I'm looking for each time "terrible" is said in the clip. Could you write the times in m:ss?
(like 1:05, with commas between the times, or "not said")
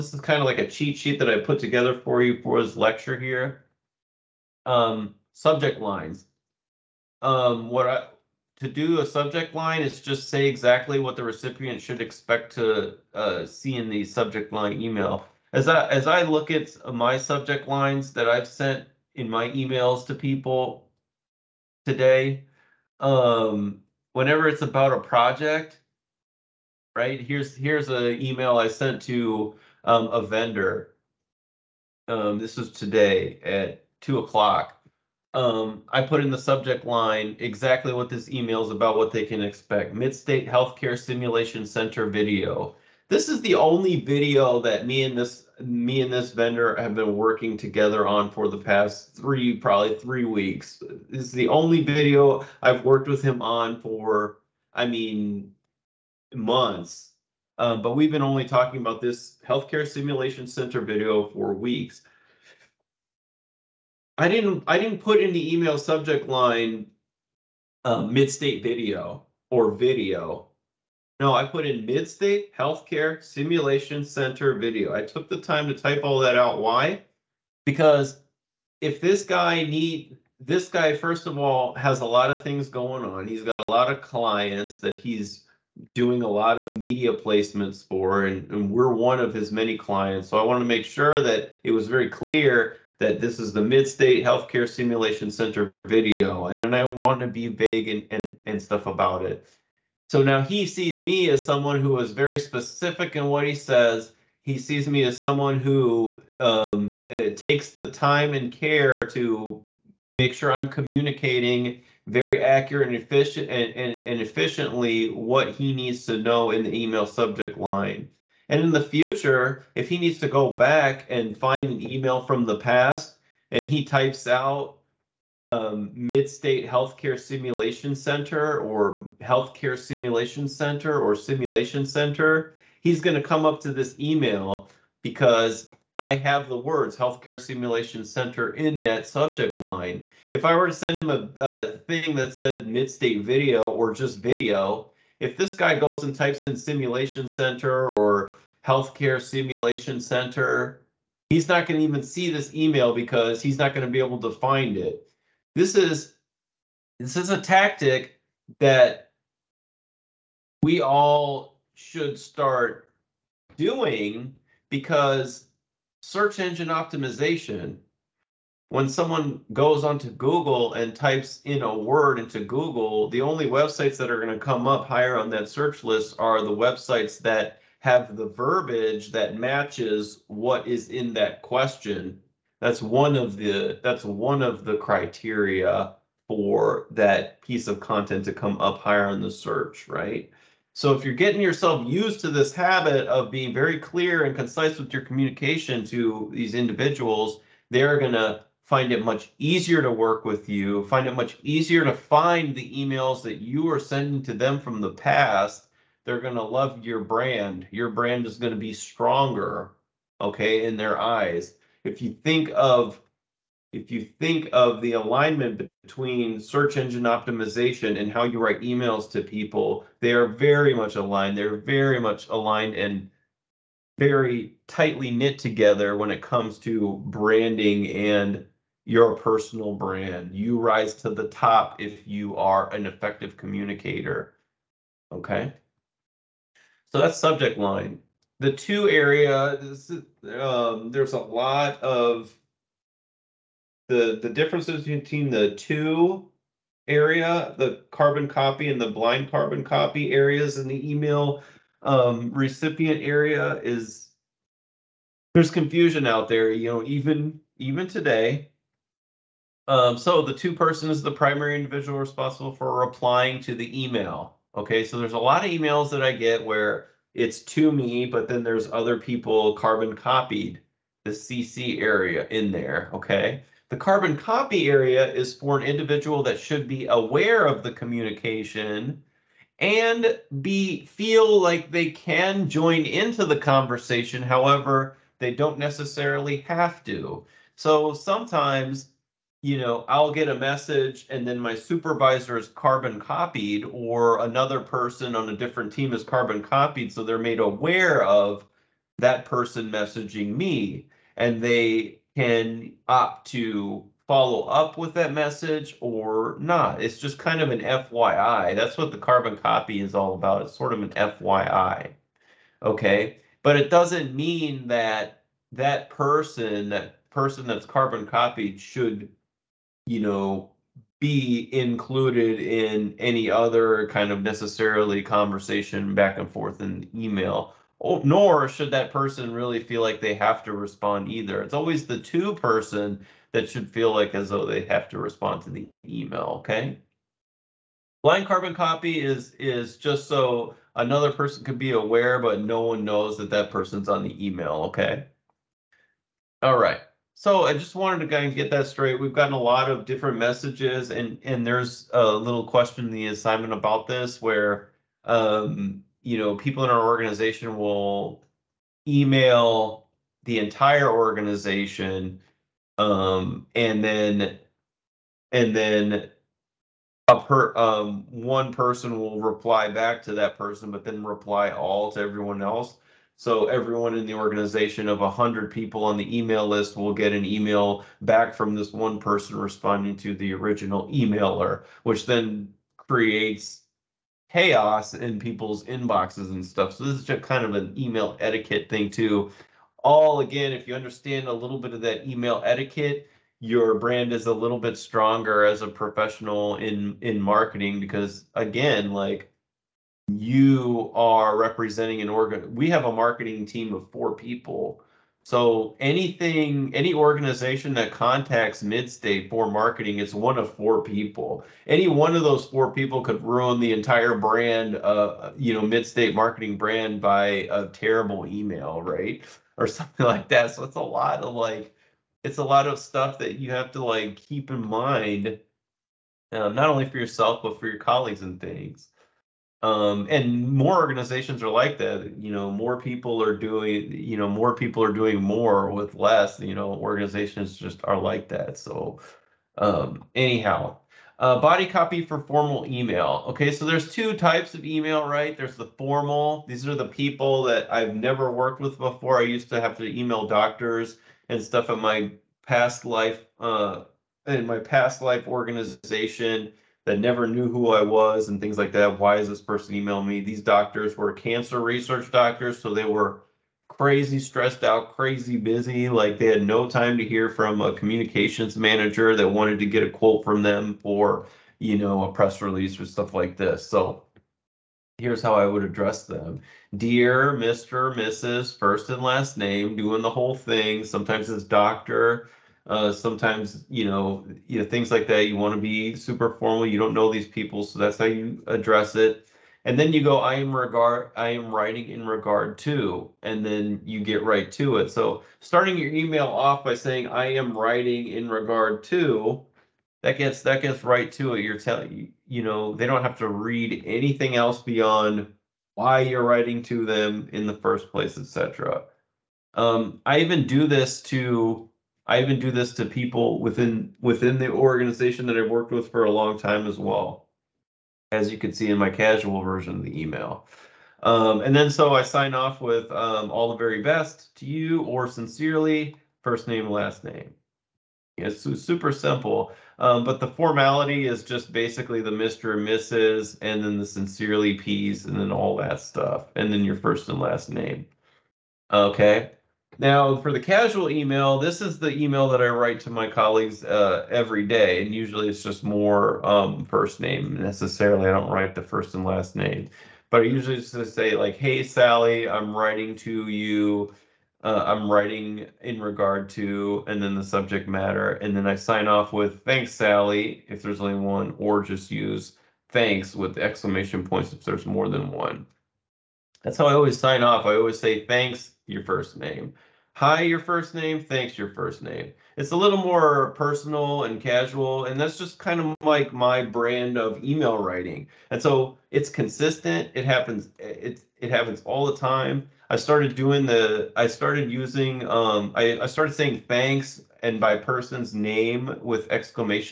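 6:57.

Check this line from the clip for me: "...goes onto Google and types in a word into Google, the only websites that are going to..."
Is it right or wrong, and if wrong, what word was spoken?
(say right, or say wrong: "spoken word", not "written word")
right.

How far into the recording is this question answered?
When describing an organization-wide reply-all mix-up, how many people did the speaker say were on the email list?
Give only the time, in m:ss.
6:14.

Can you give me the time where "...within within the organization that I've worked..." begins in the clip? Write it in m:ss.
8:33.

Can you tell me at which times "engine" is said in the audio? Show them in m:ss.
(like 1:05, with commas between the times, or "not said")
2:46, 3:36.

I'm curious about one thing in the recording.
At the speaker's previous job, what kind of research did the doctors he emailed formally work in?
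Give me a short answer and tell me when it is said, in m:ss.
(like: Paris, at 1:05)
cancer research, at 7:41.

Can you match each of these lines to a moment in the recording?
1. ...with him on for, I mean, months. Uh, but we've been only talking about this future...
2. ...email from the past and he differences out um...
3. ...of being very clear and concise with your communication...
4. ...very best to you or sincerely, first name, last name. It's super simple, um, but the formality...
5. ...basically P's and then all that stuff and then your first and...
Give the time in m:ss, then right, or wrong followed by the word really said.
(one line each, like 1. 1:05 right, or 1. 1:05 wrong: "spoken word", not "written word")
1. 0:53 wrong: "healthcare", not "future"
2. 2:01 wrong: "types", not "differences"
3. 3:13 right
4. 8:43 right
5. 8:53 wrong: "sincerely", not "basically".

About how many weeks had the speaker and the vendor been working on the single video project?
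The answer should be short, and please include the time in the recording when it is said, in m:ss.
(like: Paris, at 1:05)
3, at 0:49.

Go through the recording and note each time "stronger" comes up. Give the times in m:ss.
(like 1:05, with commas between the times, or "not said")
3:28, 6:34.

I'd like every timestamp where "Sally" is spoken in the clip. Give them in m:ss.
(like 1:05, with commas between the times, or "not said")
9:11, 9:19.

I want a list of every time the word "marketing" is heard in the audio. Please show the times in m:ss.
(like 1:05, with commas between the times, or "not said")
6:37, 6:42, 6:49, 6:56.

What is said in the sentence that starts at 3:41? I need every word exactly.
They're very much aligned and very tightly knit together when it comes to branding and your personal brand.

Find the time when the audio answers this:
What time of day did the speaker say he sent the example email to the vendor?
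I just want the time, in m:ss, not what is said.
0:34.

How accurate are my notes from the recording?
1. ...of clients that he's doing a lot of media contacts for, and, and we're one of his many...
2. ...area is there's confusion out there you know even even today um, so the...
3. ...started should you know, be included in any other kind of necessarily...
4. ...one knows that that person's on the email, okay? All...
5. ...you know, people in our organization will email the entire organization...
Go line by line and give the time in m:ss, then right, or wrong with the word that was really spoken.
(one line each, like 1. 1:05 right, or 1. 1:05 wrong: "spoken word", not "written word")
1. 1:23 wrong: "placements", not "contacts"
2. 4:13 right
3. 5:18 wrong: "copied", not "started"
4. 5:42 right
5. 5:56 right.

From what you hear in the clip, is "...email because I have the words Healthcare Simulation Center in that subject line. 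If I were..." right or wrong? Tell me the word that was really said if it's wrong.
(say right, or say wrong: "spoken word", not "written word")
right.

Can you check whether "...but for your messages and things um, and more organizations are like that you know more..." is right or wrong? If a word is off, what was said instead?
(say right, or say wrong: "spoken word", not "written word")
wrong: "colleagues", not "messages".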